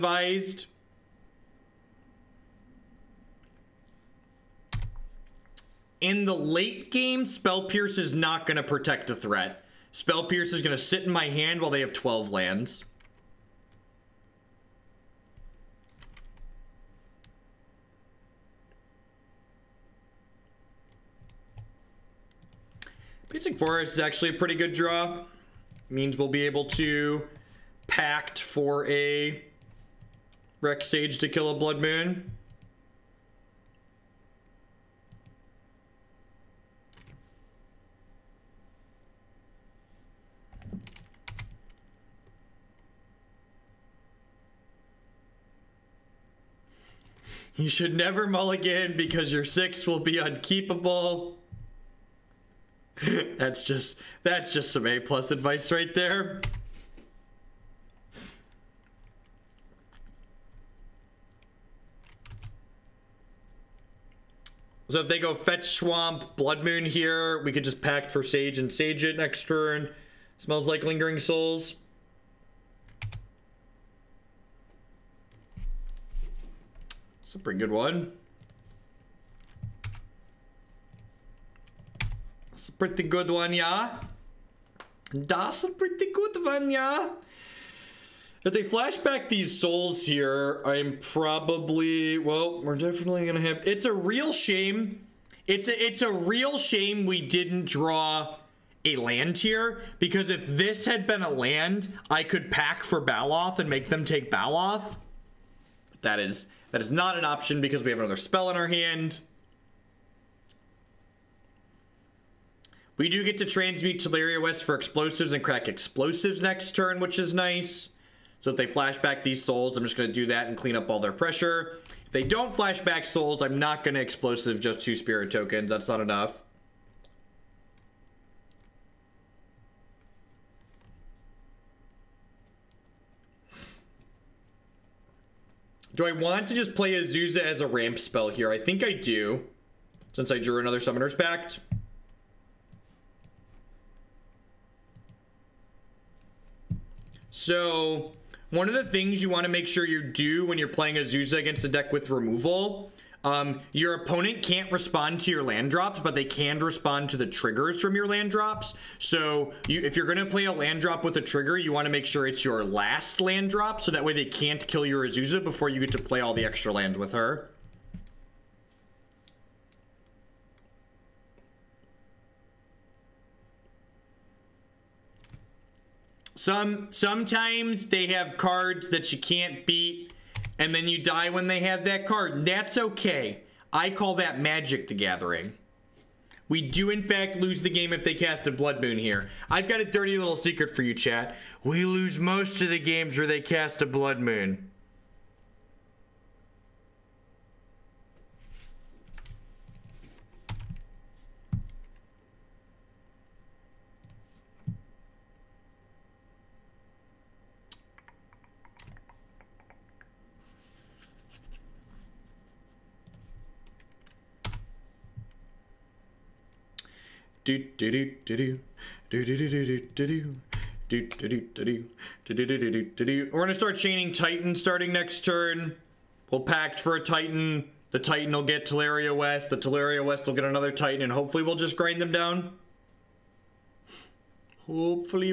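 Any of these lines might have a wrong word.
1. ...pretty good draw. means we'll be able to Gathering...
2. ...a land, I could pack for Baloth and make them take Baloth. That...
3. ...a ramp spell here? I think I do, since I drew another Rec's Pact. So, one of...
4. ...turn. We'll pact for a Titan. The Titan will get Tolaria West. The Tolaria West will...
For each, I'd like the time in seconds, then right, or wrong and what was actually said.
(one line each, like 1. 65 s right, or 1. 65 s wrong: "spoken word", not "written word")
1. 24 s wrong: "Pact", not "Gathering"
2. 101 s right
3. 137 s wrong: "Summoner", not "Rec"
4. 225 s right.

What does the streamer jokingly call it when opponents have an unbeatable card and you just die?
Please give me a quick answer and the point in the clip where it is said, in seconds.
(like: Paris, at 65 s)
Magic the Gathering, at 184 s.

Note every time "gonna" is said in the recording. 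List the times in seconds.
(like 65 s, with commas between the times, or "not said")
93 s, 217 s.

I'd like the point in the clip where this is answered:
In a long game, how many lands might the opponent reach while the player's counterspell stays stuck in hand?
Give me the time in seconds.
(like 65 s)
11 s.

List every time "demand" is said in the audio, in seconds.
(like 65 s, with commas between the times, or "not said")
not said.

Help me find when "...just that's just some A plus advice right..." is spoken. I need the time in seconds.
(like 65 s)
53 s.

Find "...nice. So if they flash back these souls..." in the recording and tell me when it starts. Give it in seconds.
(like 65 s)
117 s.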